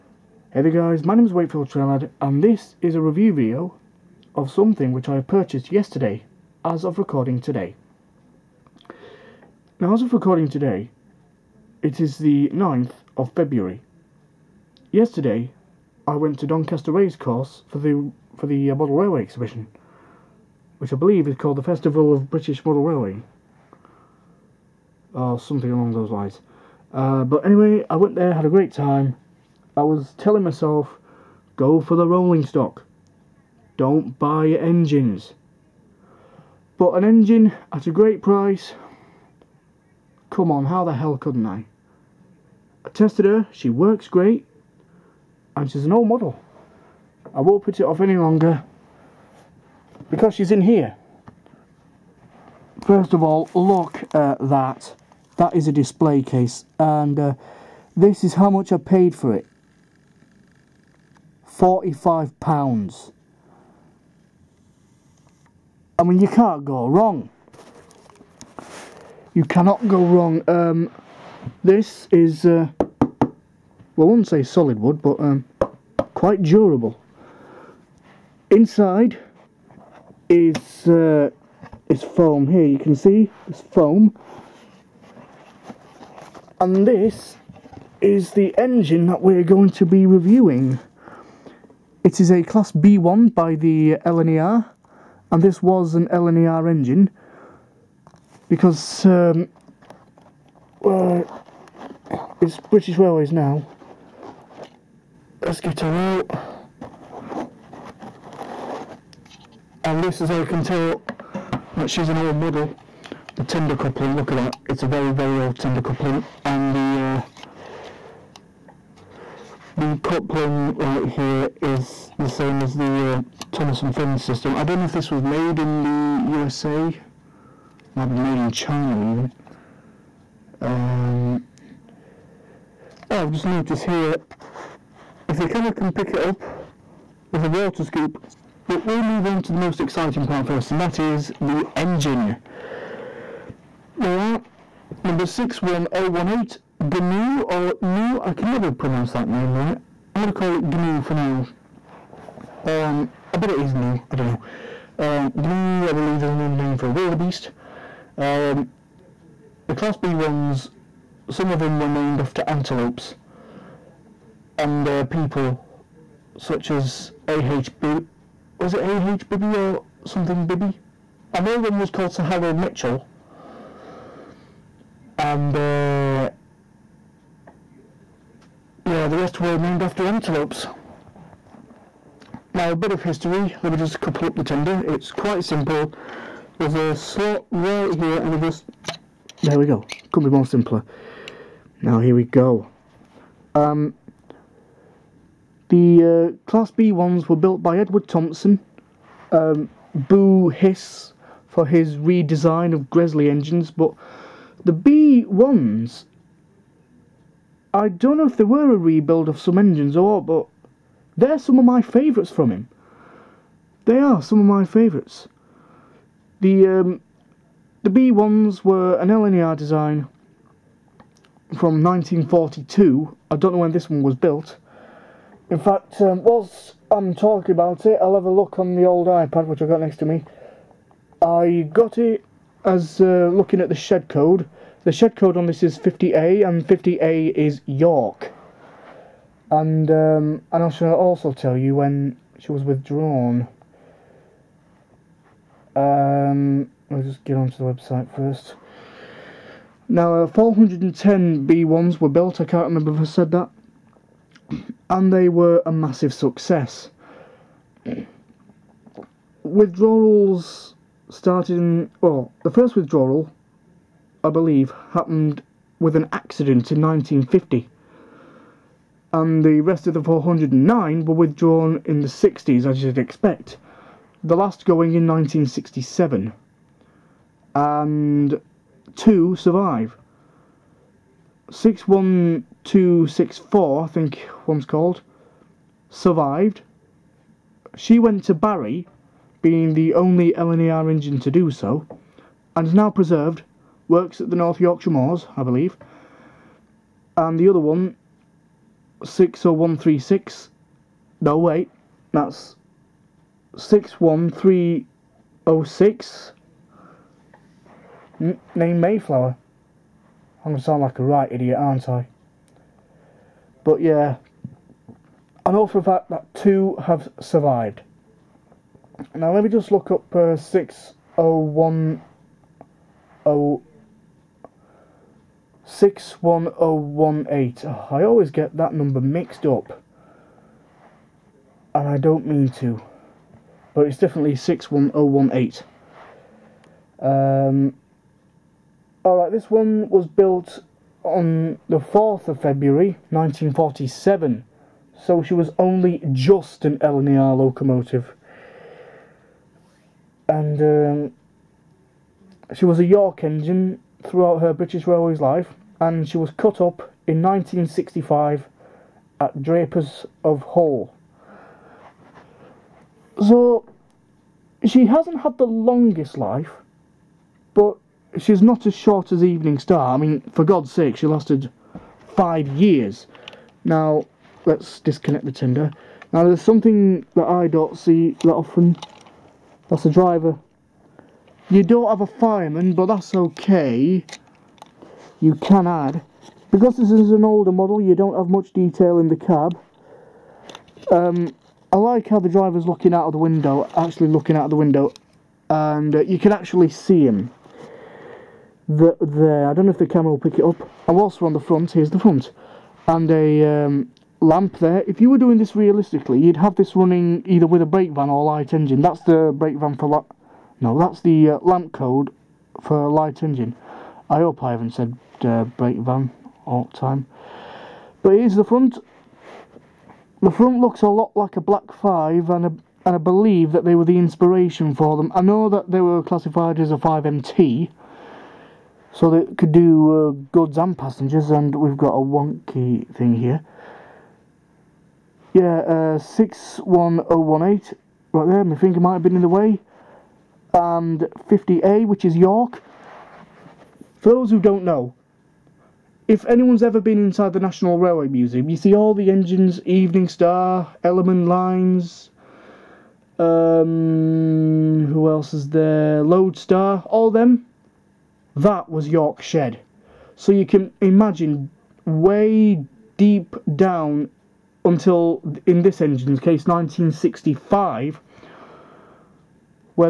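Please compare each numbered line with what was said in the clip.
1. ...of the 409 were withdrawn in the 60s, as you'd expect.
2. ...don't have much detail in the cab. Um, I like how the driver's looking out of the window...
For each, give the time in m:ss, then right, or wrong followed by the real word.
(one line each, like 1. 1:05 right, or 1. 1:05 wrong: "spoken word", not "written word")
1. 4:29 right
2. 6:27 right.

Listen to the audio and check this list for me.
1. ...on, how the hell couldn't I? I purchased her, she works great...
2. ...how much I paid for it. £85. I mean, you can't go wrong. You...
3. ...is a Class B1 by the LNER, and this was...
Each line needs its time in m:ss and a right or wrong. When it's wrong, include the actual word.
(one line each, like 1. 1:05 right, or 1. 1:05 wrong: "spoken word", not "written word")
1. 0:40 wrong: "tested", not "purchased"
2. 0:58 wrong: "45", not "85"
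3. 1:32 right.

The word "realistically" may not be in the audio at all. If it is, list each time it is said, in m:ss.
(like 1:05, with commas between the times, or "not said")
6:45.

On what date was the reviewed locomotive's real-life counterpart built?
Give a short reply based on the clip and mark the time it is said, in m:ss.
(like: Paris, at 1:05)
4 February 1947, at 5:41.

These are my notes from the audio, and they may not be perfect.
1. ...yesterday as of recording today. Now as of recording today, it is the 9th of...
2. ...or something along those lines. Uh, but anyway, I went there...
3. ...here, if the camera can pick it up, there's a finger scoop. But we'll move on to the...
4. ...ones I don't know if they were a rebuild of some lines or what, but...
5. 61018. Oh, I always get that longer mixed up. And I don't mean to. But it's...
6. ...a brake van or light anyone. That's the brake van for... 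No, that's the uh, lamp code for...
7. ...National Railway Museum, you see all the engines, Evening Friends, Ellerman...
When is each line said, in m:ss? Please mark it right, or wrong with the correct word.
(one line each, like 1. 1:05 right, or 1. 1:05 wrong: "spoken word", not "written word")
1. 0:05 right
2. 0:25 right
3. 2:13 wrong: "water", not "finger"
4. 3:25 wrong: "engines", not "lines"
5. 5:25 wrong: "number", not "longer"
6. 6:47 wrong: "engine", not "anyone"
7. 7:27 wrong: "Star", not "Friends".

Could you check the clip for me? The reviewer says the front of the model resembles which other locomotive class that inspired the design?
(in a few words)
Black 5.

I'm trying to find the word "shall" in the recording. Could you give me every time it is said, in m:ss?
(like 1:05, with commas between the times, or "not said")
4:00.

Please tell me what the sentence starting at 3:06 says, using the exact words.
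There's a slot right here and it just, there we go, couldn't be more simpler.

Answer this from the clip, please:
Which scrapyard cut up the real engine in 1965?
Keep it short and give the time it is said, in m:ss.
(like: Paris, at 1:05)
Drapers of Hull, at 5:59.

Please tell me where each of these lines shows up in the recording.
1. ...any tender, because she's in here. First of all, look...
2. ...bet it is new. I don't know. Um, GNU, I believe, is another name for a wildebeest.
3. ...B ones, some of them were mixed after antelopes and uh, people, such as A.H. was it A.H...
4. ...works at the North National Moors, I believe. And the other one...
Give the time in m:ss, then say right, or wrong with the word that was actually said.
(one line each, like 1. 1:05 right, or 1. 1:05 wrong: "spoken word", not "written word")
1. 0:47 wrong: "longer", not "tender"
2. 2:33 right
3. 2:39 wrong: "named", not "mixed"
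4. 4:53 wrong: "Yorkshire", not "National".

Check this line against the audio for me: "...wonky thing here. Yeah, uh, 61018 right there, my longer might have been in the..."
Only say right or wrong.
wrong.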